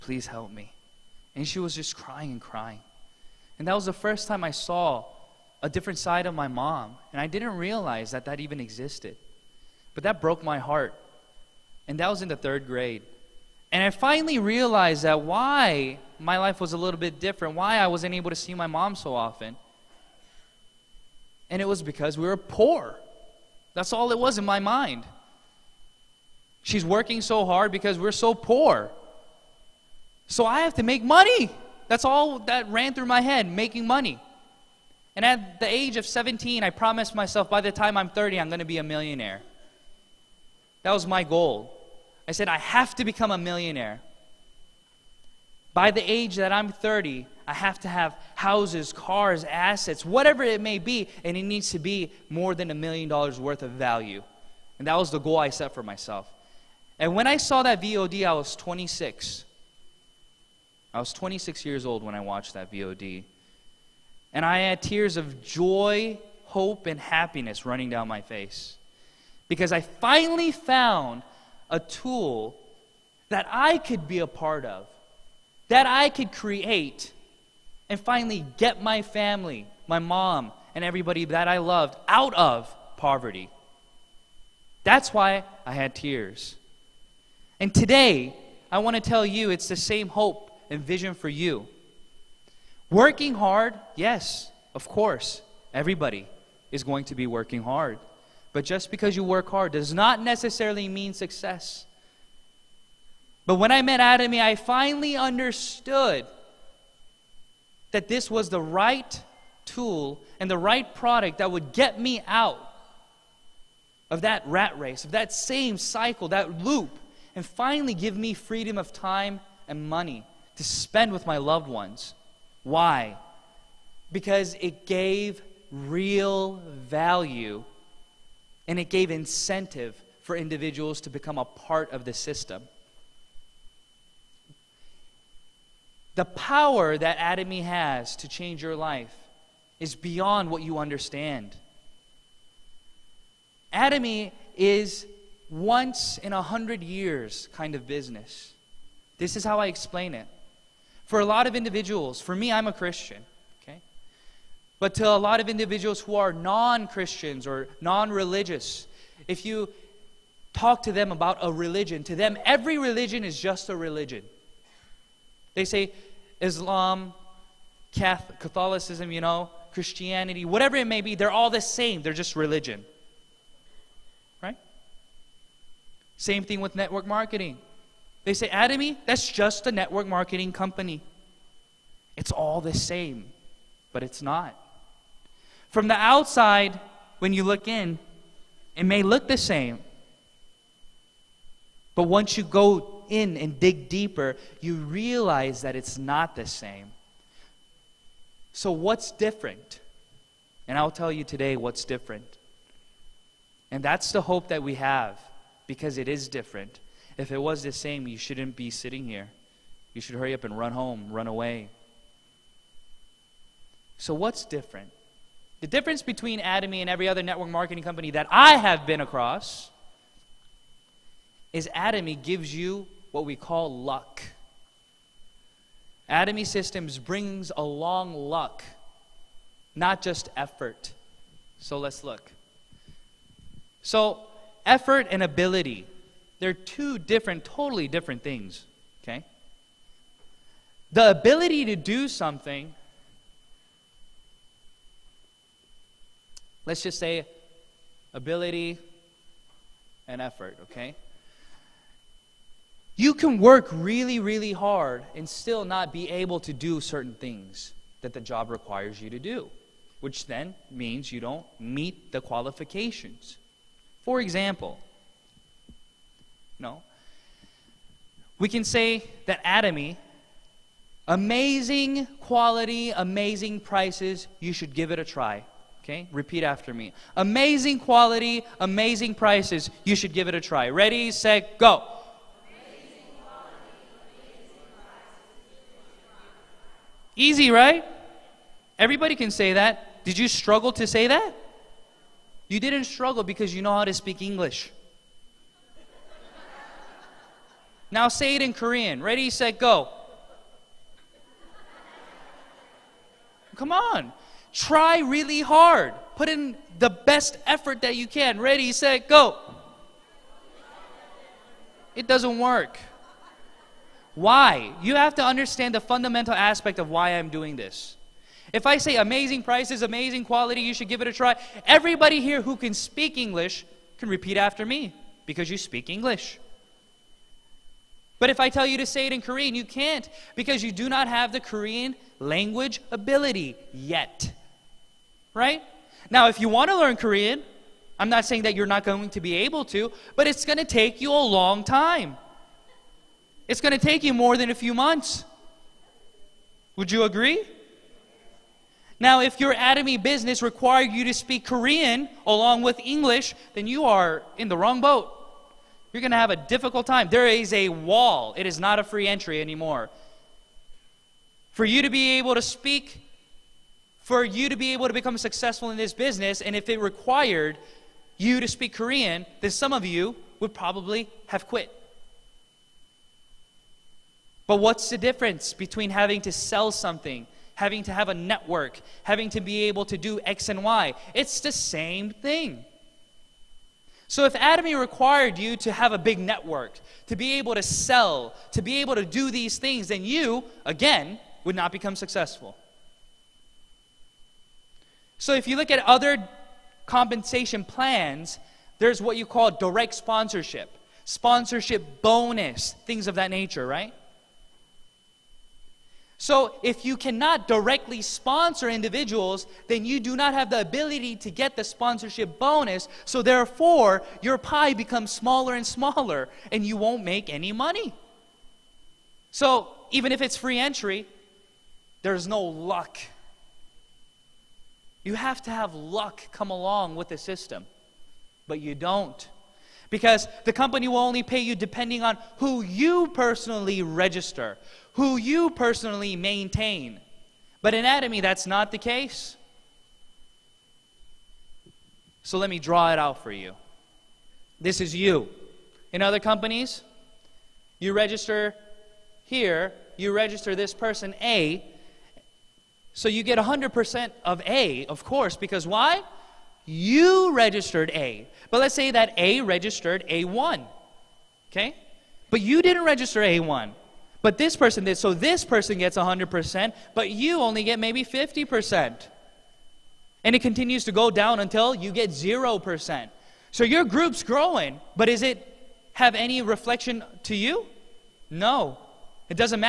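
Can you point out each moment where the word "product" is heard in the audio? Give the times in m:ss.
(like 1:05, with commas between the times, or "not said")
1:50.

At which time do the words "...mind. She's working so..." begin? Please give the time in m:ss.
0:24.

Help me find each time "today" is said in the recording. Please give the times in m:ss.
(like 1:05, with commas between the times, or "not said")
1:27, 3:21.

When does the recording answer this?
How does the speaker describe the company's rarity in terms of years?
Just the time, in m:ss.
2:25.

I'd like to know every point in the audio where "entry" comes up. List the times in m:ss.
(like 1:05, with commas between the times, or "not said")
5:59, 7:00.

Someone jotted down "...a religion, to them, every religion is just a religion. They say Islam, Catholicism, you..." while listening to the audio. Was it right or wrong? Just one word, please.
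right.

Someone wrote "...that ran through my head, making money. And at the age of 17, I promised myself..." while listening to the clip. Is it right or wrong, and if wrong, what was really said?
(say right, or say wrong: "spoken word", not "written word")
right.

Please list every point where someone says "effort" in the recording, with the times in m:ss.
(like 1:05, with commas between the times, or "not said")
3:50, 3:54, 4:10, 5:07.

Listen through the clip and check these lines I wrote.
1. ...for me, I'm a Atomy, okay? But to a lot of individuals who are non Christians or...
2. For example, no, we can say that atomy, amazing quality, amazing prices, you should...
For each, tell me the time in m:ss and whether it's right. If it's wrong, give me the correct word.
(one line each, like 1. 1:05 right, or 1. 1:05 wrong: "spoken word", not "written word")
1. 2:32 wrong: "Christian", not "Atomy"
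2. 4:24 right.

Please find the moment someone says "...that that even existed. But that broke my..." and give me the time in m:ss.
0:08.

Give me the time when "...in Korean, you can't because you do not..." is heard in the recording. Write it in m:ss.
5:29.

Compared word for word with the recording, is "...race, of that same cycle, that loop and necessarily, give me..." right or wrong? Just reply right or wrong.
wrong.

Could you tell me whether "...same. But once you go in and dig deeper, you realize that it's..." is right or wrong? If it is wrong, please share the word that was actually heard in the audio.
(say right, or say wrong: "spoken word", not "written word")
right.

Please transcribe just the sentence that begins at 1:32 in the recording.
Working hard, yes, of course, everybody is going to be working hard.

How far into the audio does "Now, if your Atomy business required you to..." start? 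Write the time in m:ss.
5:48.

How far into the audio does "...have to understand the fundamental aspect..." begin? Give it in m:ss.
5:14.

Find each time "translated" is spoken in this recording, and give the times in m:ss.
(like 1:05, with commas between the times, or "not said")
not said.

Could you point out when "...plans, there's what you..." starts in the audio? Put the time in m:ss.
6:37.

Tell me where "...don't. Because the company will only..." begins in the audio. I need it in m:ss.
7:08.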